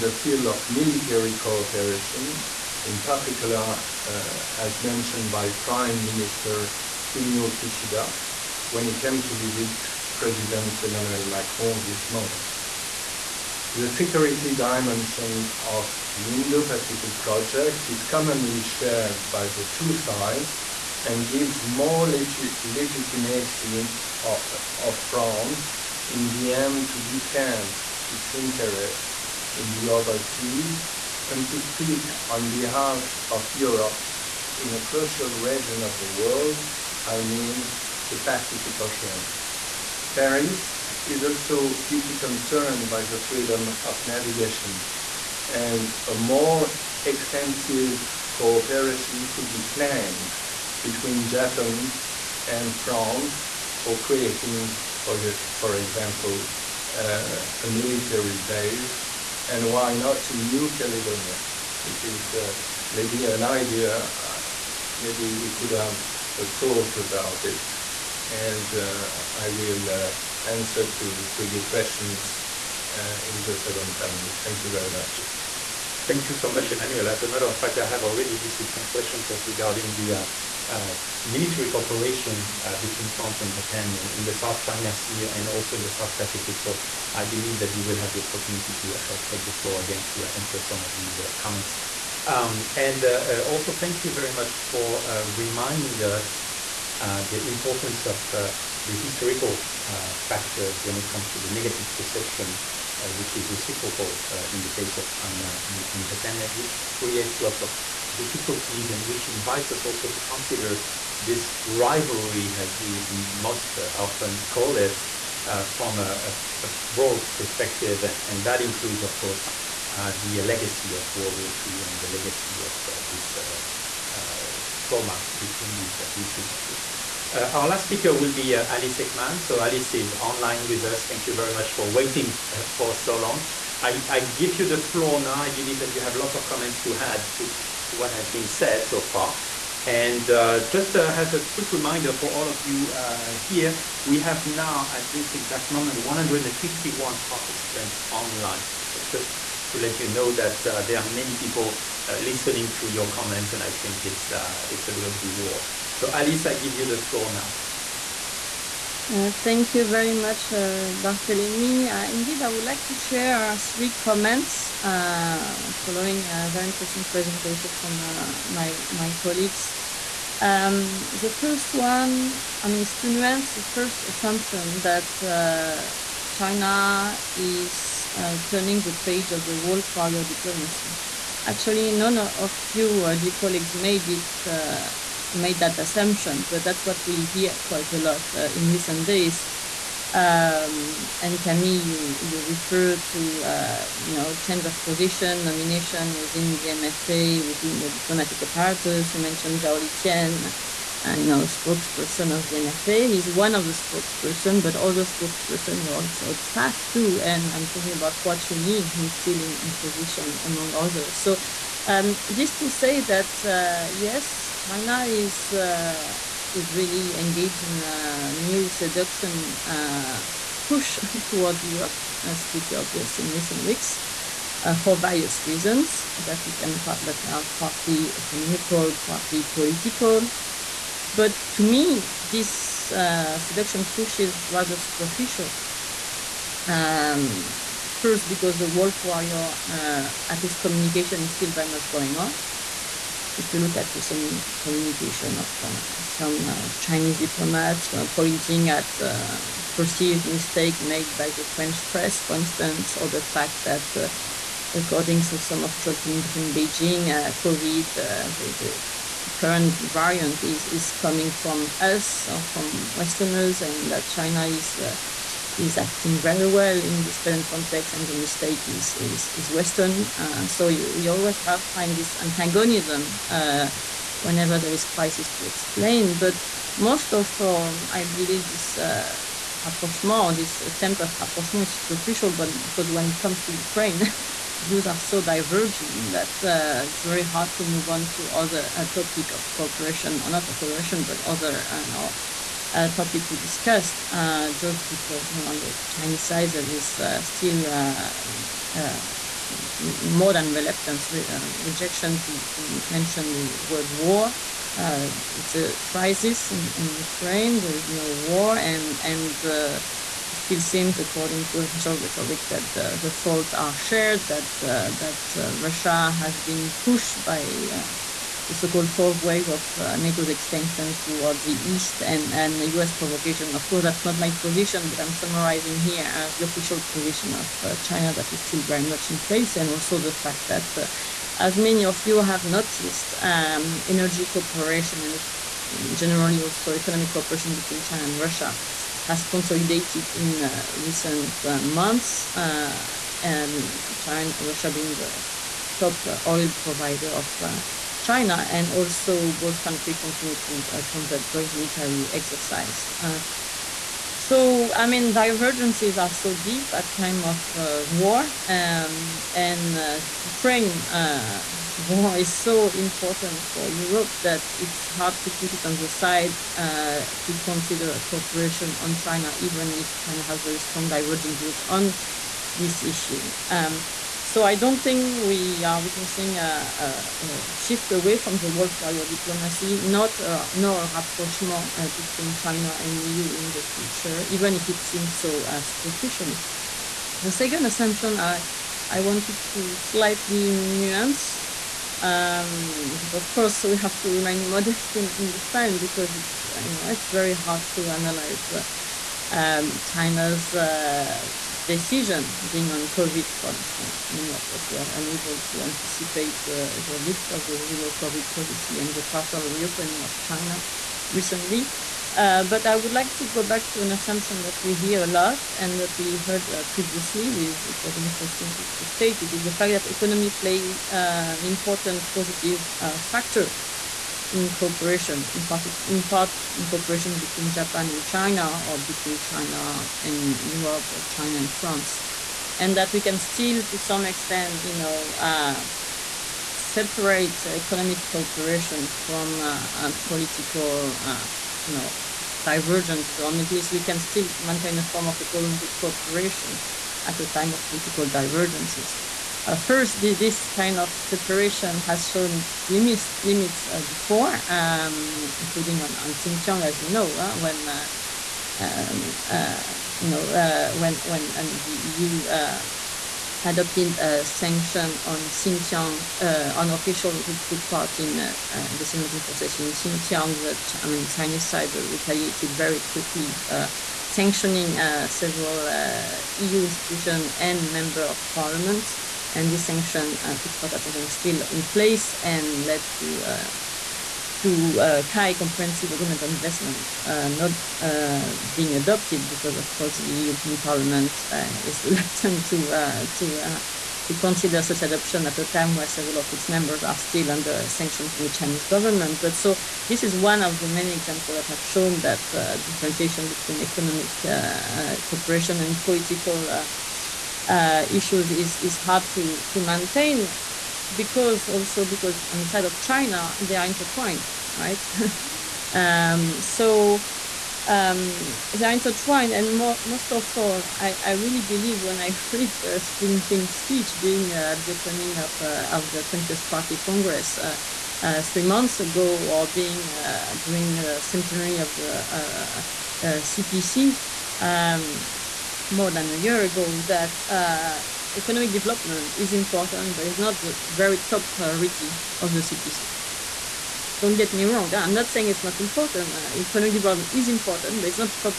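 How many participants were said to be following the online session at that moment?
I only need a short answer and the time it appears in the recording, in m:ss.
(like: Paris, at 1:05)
151, at 2:25.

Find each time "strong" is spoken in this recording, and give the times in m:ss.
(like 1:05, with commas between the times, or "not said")
6:10.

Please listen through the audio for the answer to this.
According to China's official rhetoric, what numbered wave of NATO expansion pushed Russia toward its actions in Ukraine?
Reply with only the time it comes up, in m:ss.
5:18.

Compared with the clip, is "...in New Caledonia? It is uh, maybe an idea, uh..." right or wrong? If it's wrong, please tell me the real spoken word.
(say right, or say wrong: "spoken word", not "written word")
right.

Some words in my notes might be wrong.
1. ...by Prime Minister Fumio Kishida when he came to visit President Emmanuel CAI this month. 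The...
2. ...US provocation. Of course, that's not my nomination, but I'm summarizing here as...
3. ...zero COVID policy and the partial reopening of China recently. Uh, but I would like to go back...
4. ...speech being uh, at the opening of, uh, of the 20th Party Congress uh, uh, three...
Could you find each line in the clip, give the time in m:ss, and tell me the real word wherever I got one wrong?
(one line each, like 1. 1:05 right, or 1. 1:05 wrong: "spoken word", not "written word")
1. 0:05 wrong: "Macron", not "CAI"
2. 5:22 wrong: "position", not "nomination"
3. 6:47 right
4. 8:43 right.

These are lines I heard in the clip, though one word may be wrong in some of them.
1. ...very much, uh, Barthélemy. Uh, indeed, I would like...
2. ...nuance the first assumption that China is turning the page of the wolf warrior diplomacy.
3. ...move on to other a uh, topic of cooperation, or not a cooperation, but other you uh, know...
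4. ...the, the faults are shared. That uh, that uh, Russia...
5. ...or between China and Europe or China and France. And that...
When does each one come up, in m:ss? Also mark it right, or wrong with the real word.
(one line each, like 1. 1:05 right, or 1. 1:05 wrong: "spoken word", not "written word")
1. 2:39 right
2. 2:53 right
3. 4:47 right
4. 5:12 right
5. 7:08 right.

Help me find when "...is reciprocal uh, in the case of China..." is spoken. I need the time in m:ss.
1:43.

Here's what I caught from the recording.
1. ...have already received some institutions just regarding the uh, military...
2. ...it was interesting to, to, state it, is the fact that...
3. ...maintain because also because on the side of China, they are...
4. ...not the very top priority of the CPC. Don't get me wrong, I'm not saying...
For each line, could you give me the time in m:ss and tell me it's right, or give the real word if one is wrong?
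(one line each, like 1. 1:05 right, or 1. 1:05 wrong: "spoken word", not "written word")
1. 1:17 wrong: "questions", not "institutions"
2. 6:57 right
3. 8:29 right
4. 9:00 right.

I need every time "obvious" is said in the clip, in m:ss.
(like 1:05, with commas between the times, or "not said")
3:42.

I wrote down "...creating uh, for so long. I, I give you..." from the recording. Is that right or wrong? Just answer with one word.
wrong.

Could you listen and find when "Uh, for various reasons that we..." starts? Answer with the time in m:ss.
3:44.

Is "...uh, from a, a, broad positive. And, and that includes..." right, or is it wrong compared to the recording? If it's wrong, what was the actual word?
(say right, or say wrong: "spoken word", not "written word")
wrong: "perspective", not "positive".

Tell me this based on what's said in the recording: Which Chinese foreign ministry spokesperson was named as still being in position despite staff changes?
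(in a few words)
Hua Chunying.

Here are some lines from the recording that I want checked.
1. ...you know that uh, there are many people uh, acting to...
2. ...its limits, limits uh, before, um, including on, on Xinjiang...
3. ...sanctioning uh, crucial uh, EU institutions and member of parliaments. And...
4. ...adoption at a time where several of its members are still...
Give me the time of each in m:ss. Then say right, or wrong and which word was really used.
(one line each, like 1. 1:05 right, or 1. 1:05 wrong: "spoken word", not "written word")
1. 2:29 wrong: "listening", not "acting"
2. 7:32 right
3. 7:54 wrong: "several", not "crucial"
4. 8:14 right.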